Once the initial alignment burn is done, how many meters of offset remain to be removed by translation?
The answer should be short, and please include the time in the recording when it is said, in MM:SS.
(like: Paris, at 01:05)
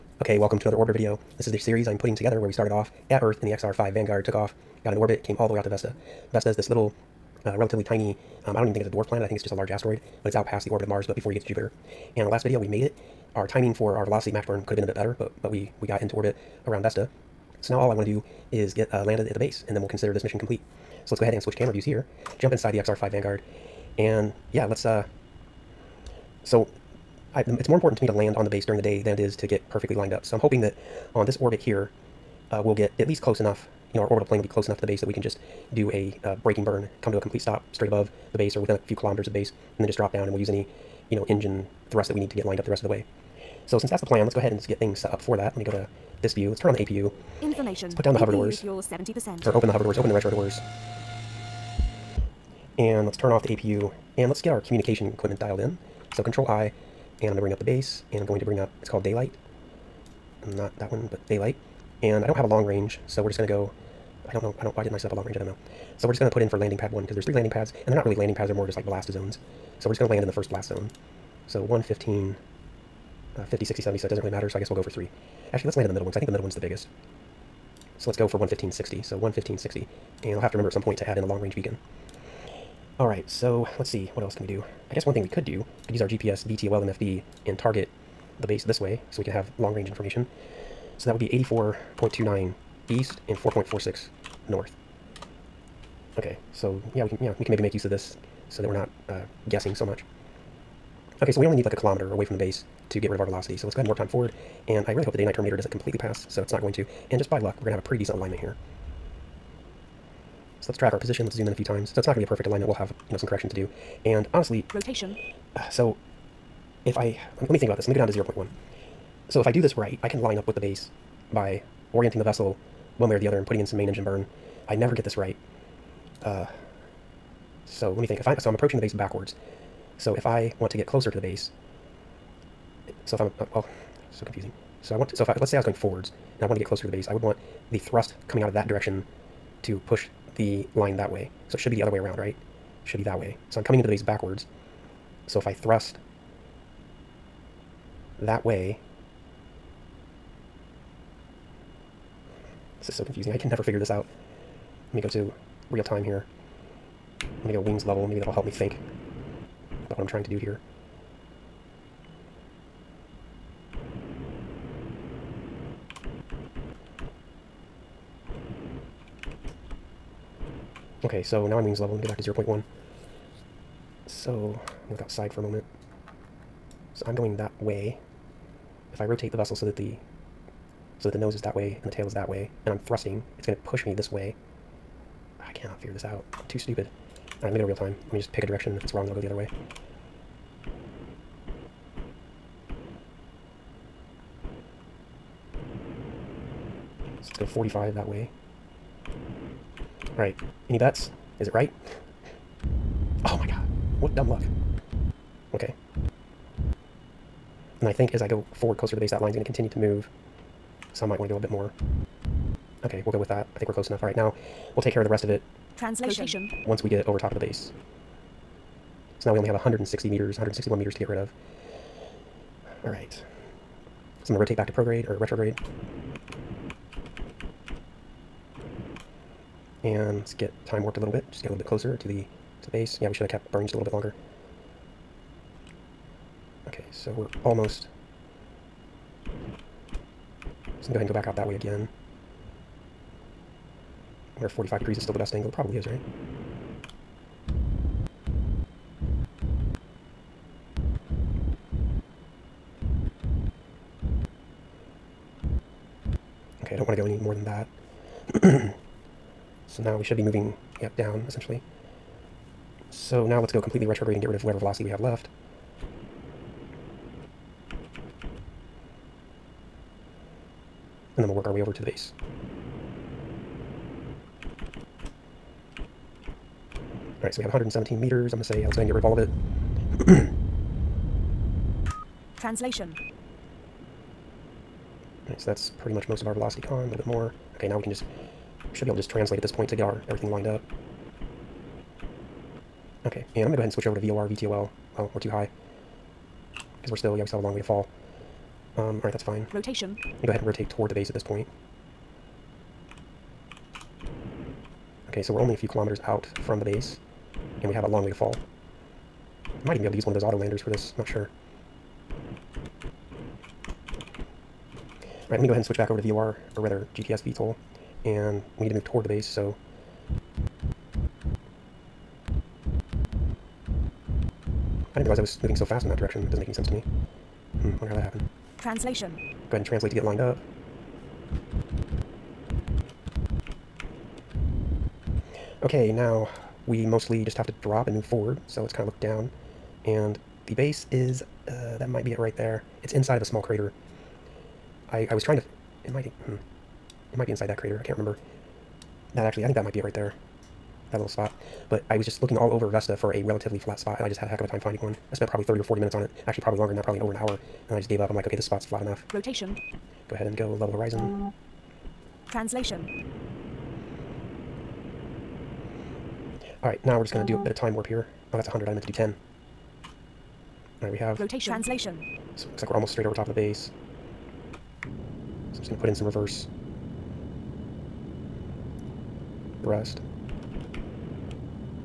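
161 meters, at 03:40.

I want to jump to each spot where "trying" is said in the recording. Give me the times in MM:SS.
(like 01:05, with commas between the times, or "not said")
02:40, 05:45.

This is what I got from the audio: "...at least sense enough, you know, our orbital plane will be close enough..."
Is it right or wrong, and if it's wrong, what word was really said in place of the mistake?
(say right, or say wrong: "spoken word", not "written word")
wrong: "close", not "sense".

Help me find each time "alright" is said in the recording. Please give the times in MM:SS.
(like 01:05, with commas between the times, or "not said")
04:59, 06:06, 06:10.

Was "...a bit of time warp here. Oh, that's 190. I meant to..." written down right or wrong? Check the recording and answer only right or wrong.
wrong.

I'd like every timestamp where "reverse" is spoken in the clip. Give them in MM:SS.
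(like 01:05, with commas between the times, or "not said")
06:16.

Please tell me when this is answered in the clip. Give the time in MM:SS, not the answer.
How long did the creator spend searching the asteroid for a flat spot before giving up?
05:57.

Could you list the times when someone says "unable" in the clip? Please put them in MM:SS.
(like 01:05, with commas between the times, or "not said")
not said.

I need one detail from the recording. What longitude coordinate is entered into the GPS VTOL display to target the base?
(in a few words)
84.29 east.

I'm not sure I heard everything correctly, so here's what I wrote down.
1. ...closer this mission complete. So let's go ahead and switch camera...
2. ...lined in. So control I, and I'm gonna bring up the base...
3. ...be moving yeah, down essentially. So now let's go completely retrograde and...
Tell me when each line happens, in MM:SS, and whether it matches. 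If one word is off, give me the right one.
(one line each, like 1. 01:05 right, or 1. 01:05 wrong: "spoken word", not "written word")
1. 00:19 wrong: "consider", not "closer"
2. 00:55 wrong: "dialed", not "lined"
3. 04:20 right.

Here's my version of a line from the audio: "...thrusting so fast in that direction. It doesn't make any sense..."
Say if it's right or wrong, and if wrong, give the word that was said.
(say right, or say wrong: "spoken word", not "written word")
wrong: "moving", not "thrusting".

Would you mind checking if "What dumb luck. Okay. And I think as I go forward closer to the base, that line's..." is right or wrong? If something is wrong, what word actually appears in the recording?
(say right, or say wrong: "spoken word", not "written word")
right.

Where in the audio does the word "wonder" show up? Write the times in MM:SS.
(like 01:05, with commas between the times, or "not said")
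04:04, 05:27.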